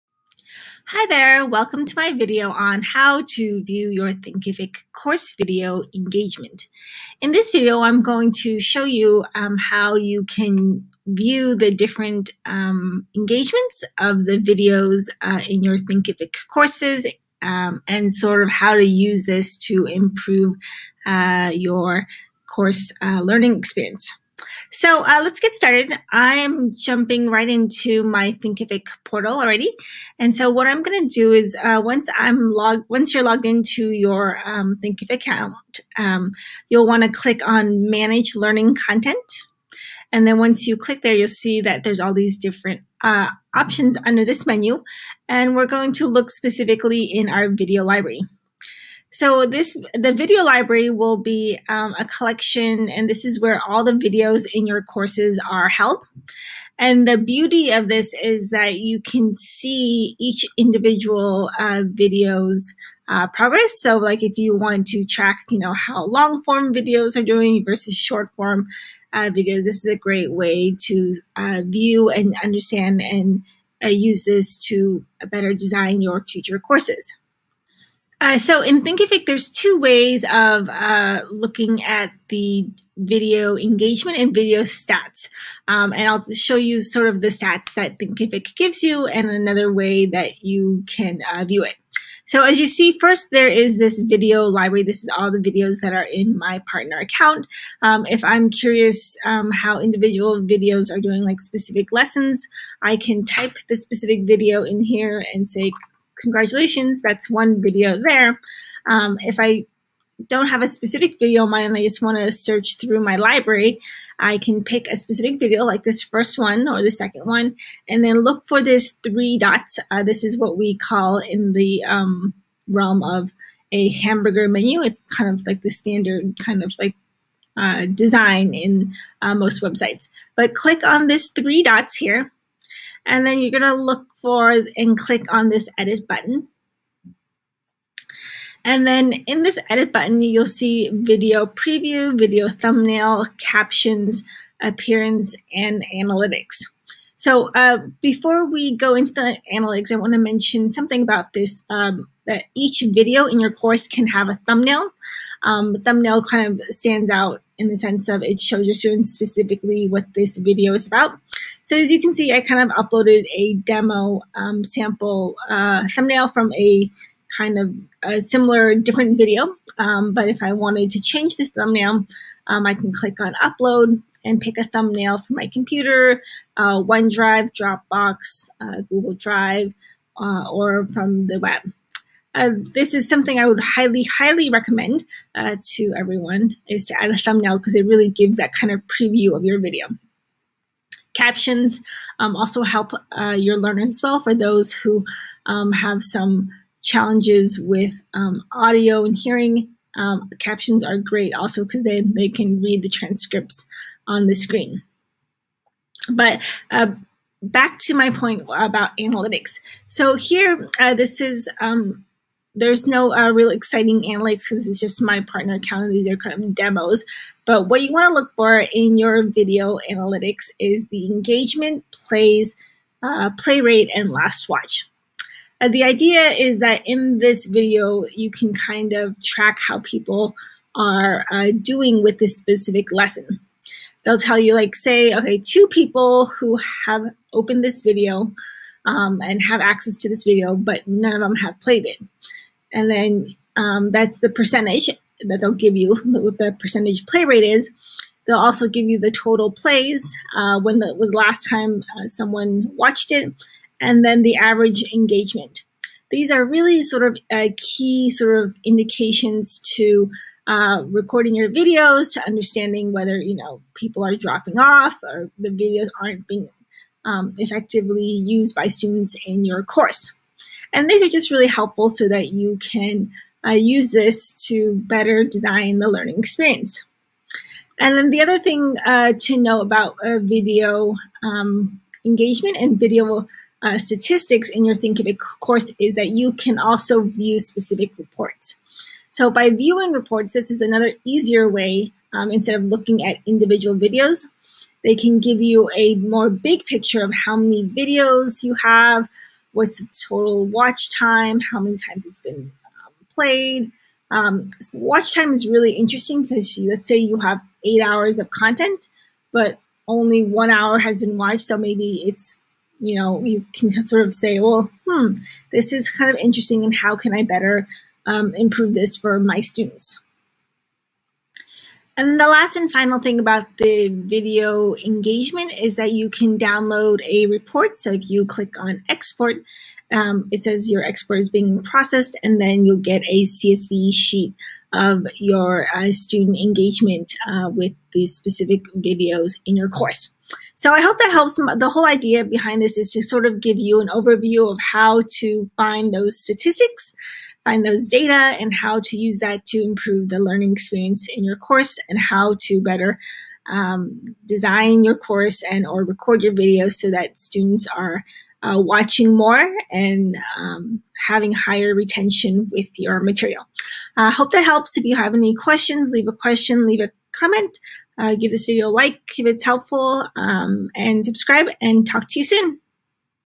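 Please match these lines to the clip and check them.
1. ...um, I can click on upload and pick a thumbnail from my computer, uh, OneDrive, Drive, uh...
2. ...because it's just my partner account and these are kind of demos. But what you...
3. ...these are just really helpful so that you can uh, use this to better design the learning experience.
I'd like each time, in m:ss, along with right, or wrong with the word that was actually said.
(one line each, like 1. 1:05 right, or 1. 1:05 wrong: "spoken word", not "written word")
1. 2:52 wrong: "Dropbox", not "Drive"
2. 3:34 right
3. 4:30 right.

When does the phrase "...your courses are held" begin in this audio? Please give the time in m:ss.
0:54.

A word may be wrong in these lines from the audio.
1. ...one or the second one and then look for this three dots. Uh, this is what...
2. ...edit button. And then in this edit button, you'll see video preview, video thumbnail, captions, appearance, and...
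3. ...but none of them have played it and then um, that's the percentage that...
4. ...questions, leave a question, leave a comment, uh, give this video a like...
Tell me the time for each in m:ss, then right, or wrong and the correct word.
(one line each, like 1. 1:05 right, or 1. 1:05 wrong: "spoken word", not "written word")
1. 1:56 right
2. 2:15 right
3. 4:00 right
4. 6:05 right.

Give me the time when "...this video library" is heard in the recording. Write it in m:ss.
1:33.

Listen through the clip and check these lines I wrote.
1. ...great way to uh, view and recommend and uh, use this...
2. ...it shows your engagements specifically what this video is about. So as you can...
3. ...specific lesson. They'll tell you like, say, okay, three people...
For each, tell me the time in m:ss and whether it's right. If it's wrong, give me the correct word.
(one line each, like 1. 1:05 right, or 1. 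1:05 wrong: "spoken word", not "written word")
1. 1:09 wrong: "understand", not "recommend"
2. 2:38 wrong: "students", not "engagements"
3. 3:52 wrong: "two", not "three".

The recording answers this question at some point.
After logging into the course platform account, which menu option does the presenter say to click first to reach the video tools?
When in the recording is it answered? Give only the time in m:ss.
0:37.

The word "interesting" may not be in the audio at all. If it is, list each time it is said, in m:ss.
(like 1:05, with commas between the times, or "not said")
5:05, 5:16.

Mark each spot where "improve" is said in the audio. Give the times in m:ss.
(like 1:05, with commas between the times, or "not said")
0:19, 5:18, 5:49.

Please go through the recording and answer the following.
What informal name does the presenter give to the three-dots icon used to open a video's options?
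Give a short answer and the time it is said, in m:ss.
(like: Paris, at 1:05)
Hamburger menu, at 2:03.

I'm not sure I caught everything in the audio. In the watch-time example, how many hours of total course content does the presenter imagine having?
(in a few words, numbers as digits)
8 hours.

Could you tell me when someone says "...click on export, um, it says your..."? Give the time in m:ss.
5:28.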